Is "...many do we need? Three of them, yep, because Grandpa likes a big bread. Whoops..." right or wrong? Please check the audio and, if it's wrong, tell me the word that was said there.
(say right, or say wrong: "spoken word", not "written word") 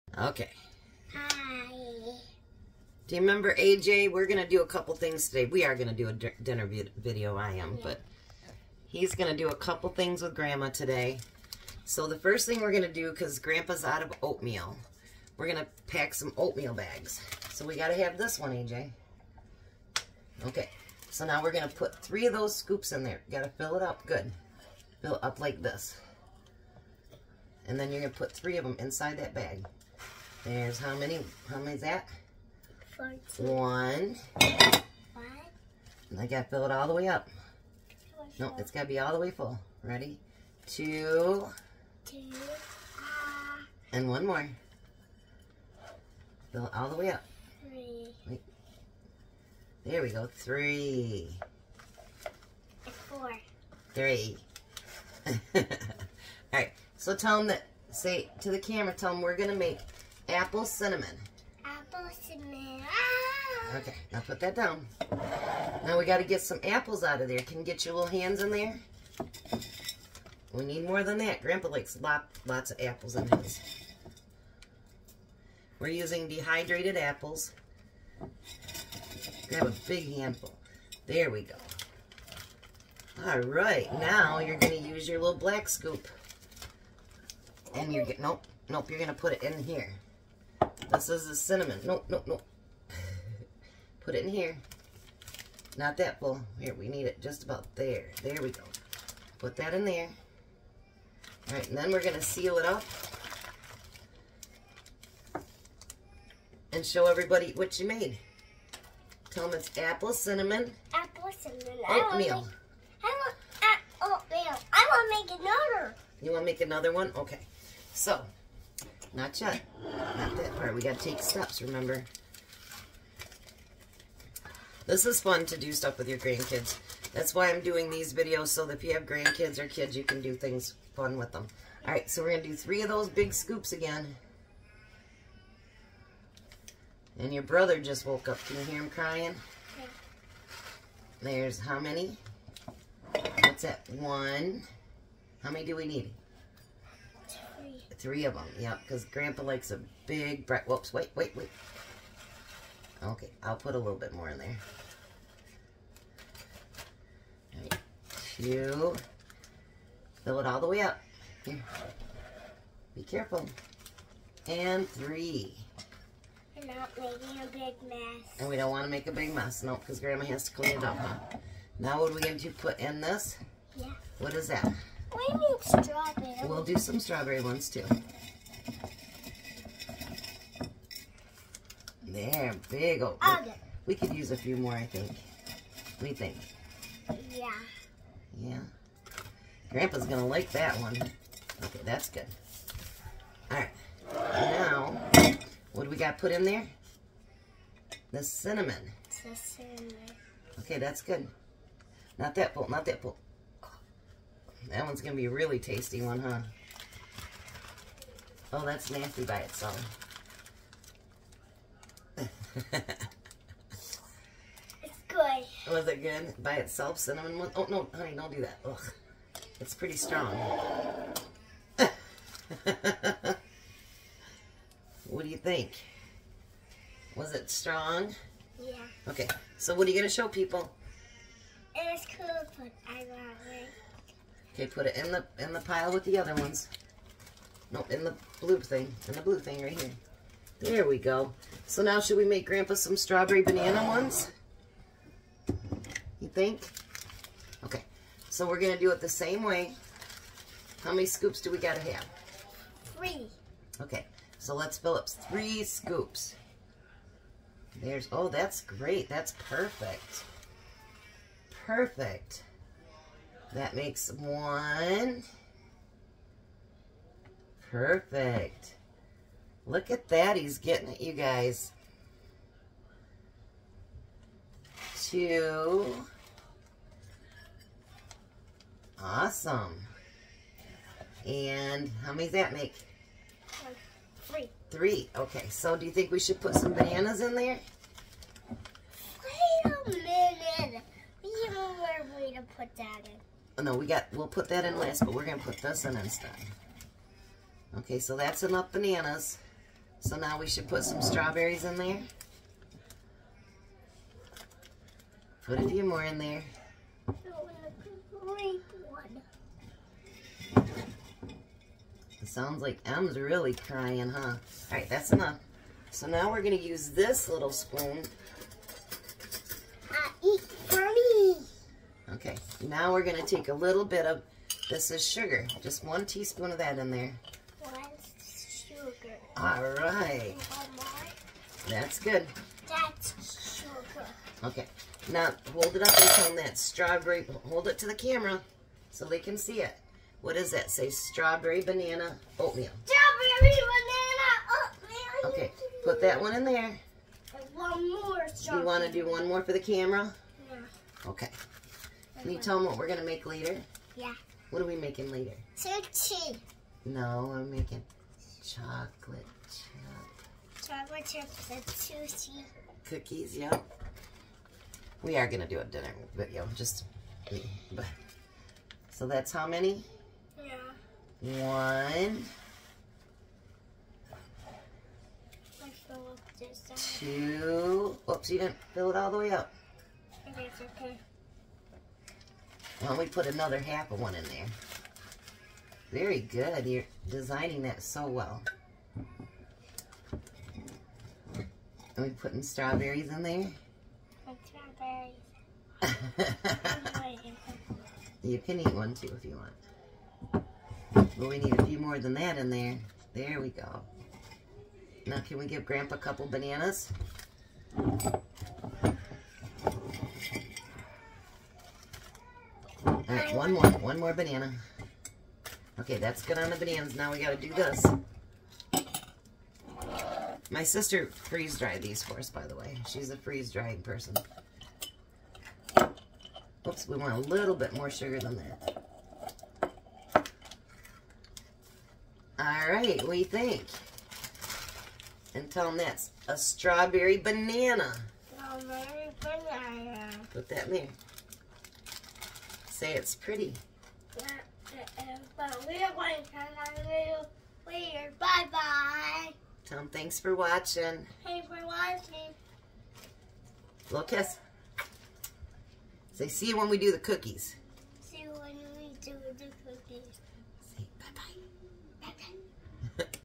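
right.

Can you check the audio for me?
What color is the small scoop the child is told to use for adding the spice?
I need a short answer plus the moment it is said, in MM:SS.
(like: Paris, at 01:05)
Black, at 01:25.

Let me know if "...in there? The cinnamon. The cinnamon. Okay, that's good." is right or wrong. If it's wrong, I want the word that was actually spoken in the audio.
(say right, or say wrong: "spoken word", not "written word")
right.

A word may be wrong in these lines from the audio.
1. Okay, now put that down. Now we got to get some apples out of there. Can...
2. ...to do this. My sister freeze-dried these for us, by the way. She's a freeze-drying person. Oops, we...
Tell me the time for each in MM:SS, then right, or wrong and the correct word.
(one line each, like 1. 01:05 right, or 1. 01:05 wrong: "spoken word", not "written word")
1. 01:03 right
2. 06:57 right.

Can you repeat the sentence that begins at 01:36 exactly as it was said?
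Here, we need it just about there.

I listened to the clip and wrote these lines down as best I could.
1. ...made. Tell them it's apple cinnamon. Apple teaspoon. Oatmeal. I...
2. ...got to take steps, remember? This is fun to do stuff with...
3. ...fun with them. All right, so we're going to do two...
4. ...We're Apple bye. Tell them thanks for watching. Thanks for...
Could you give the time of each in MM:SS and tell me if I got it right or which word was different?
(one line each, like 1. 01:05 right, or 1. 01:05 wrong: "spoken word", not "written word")
1. 01:47 wrong: "cinnamon", not "teaspoon"
2. 02:00 right
3. 02:10 wrong: "three", not "two"
4. 07:27 wrong: "Bye", not "Apple".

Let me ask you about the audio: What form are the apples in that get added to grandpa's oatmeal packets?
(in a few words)
Dehydrated.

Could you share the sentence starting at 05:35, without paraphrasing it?
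Now, hold it up and that strawberry, hold it to the camera so they can see it.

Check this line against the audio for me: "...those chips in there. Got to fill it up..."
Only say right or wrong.
wrong.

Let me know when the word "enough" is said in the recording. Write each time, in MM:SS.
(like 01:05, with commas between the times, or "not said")
04:58, 05:15.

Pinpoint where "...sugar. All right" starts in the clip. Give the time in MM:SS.
05:28.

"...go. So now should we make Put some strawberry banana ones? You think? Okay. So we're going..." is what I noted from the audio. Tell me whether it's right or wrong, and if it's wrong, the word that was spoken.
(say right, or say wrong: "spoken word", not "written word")
wrong: "Grandpa", not "Put".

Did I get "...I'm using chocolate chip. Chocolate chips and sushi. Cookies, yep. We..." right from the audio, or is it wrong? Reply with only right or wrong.
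wrong.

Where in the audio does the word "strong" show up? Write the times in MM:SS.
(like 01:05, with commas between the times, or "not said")
03:39, 03:47.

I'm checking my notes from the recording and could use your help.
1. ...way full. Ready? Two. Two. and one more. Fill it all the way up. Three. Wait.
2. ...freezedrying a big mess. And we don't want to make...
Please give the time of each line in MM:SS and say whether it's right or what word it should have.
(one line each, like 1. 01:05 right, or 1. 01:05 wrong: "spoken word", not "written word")
1. 00:39 right
2. 02:46 wrong: "making", not "freezedrying".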